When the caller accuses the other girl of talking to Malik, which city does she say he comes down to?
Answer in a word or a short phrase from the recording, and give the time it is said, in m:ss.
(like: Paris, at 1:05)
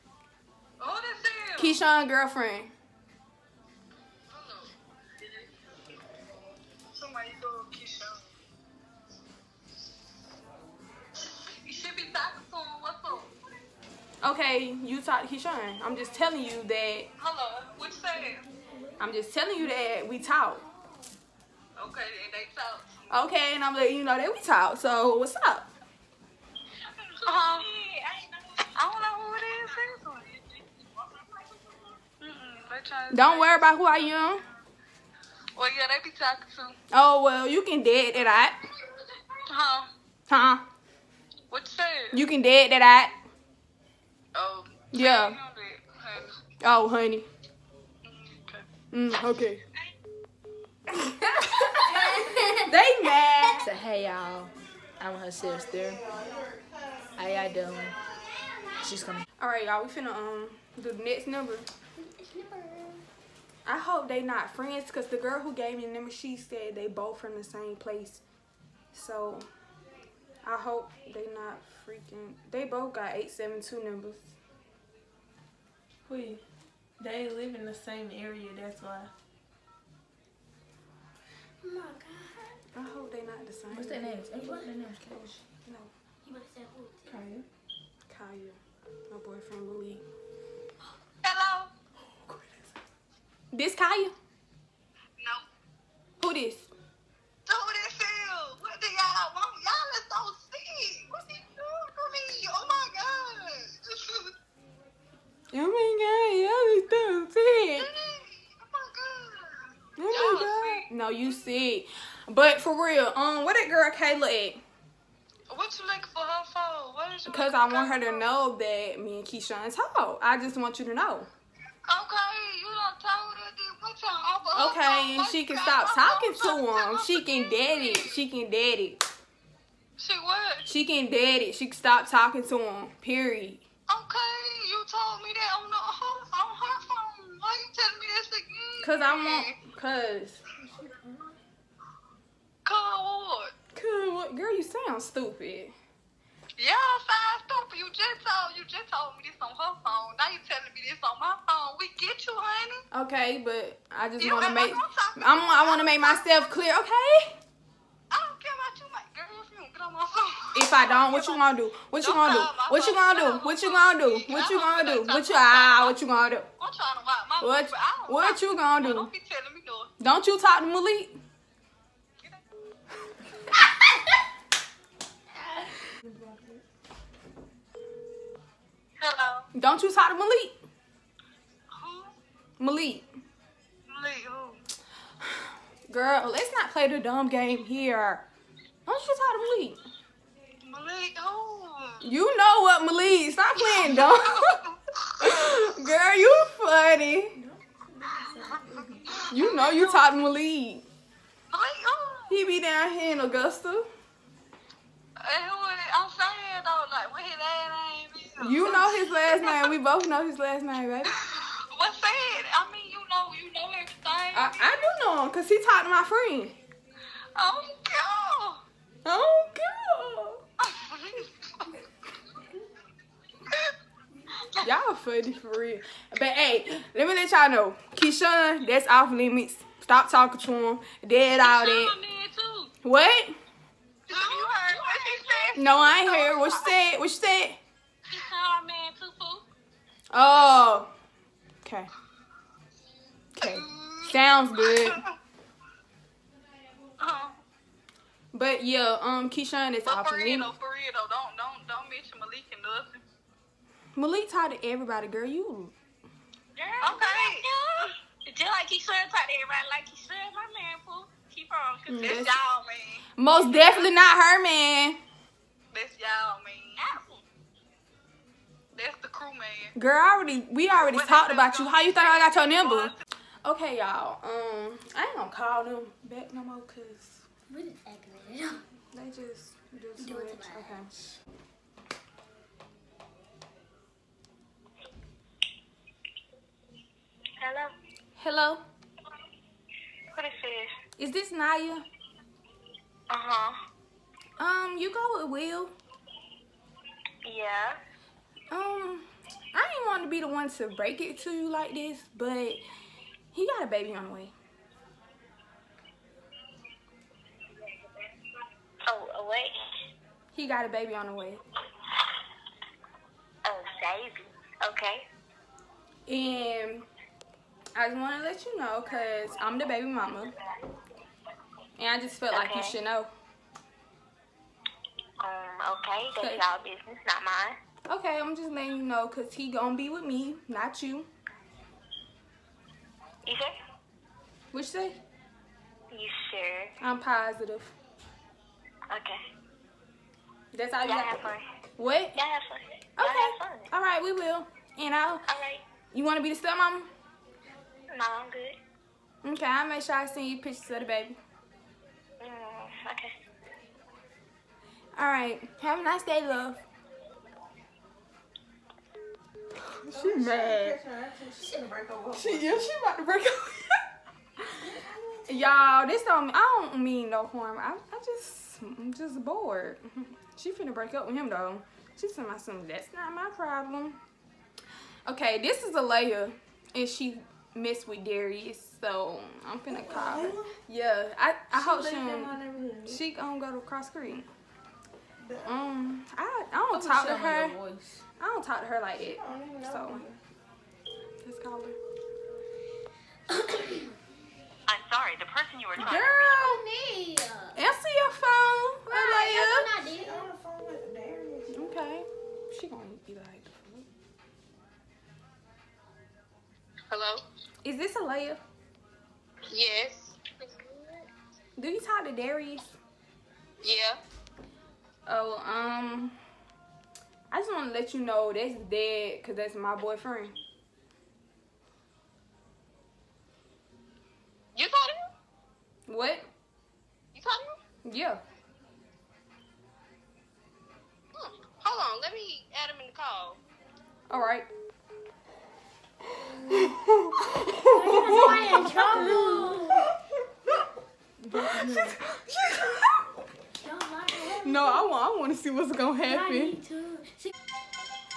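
Augusta, at 3:23.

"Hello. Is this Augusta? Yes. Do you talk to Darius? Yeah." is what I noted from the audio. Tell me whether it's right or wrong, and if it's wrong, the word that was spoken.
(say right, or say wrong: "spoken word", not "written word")
wrong: "Alaya", not "Augusta".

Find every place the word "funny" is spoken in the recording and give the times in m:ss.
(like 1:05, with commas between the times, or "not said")
3:16, 3:44.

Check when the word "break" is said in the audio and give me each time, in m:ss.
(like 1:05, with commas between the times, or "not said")
5:00, 6:03, 6:10.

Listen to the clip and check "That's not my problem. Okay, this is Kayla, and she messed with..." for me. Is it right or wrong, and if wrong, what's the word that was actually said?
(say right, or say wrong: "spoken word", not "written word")
wrong: "Alea", not "Kayla".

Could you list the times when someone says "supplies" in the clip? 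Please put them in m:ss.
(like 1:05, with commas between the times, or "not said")
not said.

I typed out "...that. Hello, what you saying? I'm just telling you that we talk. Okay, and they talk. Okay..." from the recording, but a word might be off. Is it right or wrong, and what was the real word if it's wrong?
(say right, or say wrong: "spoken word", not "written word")
right.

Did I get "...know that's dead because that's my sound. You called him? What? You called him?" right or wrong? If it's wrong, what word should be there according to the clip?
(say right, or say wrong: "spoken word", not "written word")
wrong: "boyfriend", not "sound".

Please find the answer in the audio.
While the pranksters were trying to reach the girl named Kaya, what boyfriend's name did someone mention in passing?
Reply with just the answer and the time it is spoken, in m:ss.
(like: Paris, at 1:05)
Louis, at 1:29.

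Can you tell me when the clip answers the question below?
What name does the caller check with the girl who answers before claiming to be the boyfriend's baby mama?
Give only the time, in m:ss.
4:51.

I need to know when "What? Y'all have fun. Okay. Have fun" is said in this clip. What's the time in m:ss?
5:41.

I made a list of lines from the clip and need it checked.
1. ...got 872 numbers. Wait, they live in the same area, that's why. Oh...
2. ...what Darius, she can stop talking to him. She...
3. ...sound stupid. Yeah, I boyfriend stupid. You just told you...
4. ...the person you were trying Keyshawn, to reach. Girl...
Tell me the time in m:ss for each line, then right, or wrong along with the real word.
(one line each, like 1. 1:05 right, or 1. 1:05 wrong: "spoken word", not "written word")
1. 1:12 right
2. 2:04 wrong: "Okay", not "Darius"
3. 2:24 wrong: "sound", not "boyfriend"
4. 6:35 wrong: "Girl", not "Keyshawn".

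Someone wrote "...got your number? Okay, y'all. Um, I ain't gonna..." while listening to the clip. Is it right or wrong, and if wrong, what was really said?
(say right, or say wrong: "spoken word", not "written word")
right.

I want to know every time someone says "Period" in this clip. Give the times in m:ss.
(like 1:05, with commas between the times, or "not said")
2:13.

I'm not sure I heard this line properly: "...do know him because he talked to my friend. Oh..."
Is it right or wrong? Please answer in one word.
right.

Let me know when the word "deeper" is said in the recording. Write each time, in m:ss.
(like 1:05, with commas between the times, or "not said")
not said.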